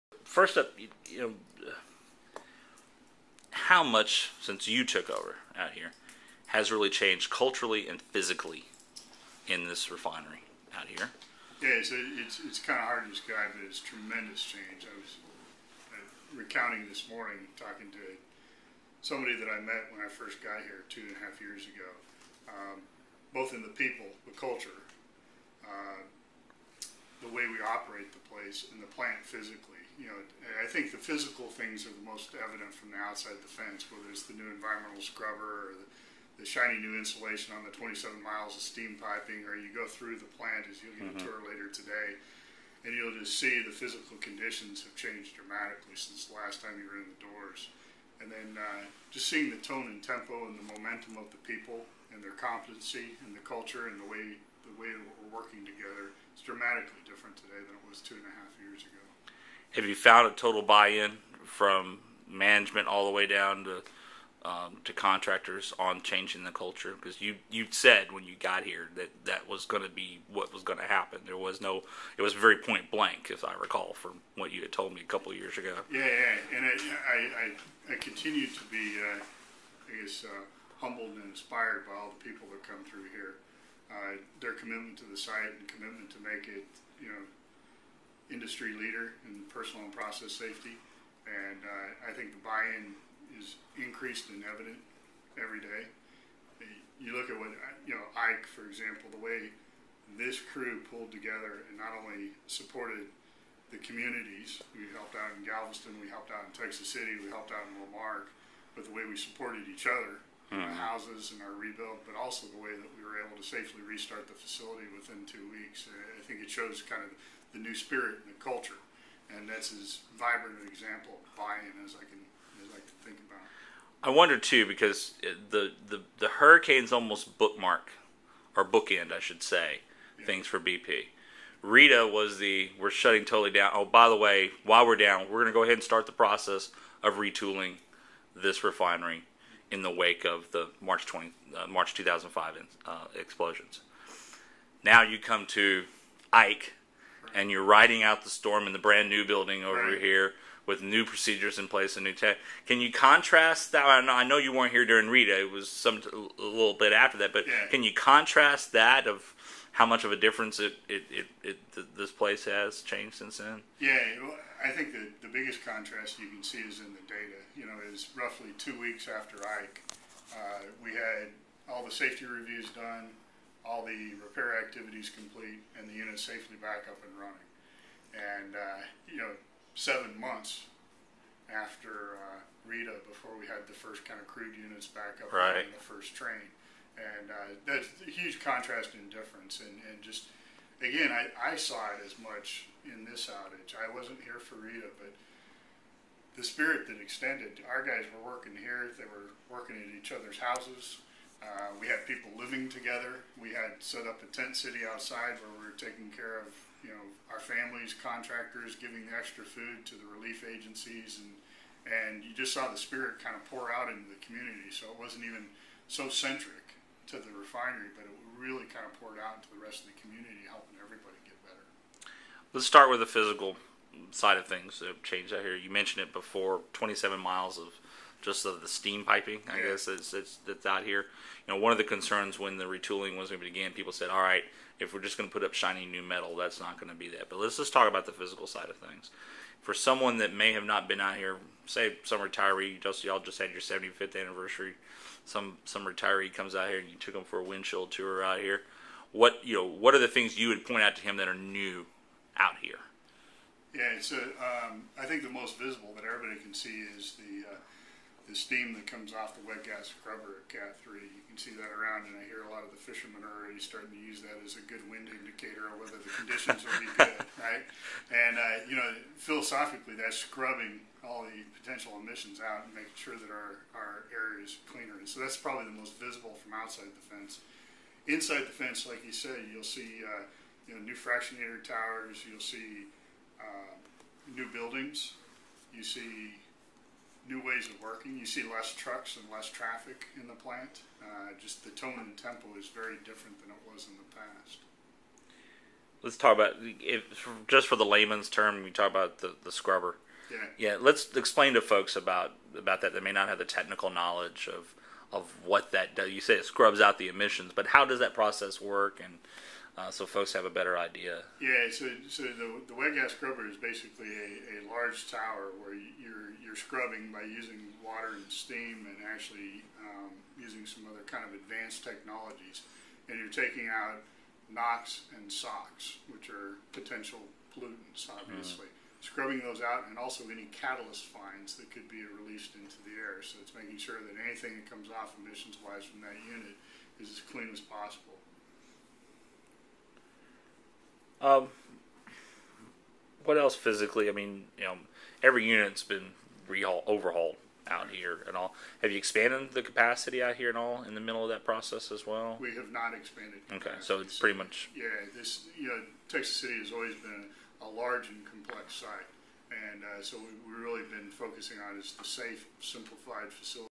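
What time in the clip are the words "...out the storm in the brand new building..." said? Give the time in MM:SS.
02:28.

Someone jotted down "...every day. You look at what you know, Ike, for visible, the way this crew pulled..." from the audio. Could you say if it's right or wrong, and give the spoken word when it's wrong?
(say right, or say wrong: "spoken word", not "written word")
wrong: "example", not "visible".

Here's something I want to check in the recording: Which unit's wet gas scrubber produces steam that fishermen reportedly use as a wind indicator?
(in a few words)
Cat 3.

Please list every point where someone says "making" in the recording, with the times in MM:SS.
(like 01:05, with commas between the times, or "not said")
04:32, 05:33.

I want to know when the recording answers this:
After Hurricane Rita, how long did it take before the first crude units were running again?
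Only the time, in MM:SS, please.
02:59.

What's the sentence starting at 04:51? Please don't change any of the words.
Uh, just the tone and tempo is very different than it was in the past.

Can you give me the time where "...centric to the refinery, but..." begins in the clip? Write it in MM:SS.
03:36.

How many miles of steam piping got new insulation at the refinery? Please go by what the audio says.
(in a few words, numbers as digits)
27.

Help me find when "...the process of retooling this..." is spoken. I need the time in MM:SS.
02:16.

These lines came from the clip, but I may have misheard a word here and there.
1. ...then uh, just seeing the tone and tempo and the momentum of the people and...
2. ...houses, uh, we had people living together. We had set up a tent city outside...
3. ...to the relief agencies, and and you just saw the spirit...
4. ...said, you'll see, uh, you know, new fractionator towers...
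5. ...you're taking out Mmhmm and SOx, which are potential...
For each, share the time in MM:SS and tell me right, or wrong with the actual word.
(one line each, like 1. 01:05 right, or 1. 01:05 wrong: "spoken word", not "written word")
1. 00:48 right
2. 03:20 right
3. 03:29 right
4. 04:39 right
5. 05:23 wrong: "NOx", not "Mmhmm".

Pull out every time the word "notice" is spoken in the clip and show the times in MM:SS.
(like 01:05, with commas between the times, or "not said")
not said.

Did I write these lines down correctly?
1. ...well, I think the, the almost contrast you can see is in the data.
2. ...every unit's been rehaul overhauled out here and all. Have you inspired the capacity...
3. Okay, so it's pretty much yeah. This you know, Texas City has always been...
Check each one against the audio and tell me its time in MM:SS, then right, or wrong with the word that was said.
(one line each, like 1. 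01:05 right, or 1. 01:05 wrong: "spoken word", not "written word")
1. 02:44 wrong: "biggest", not "almost"
2. 05:45 wrong: "expanded", not "inspired"
3. 05:53 right.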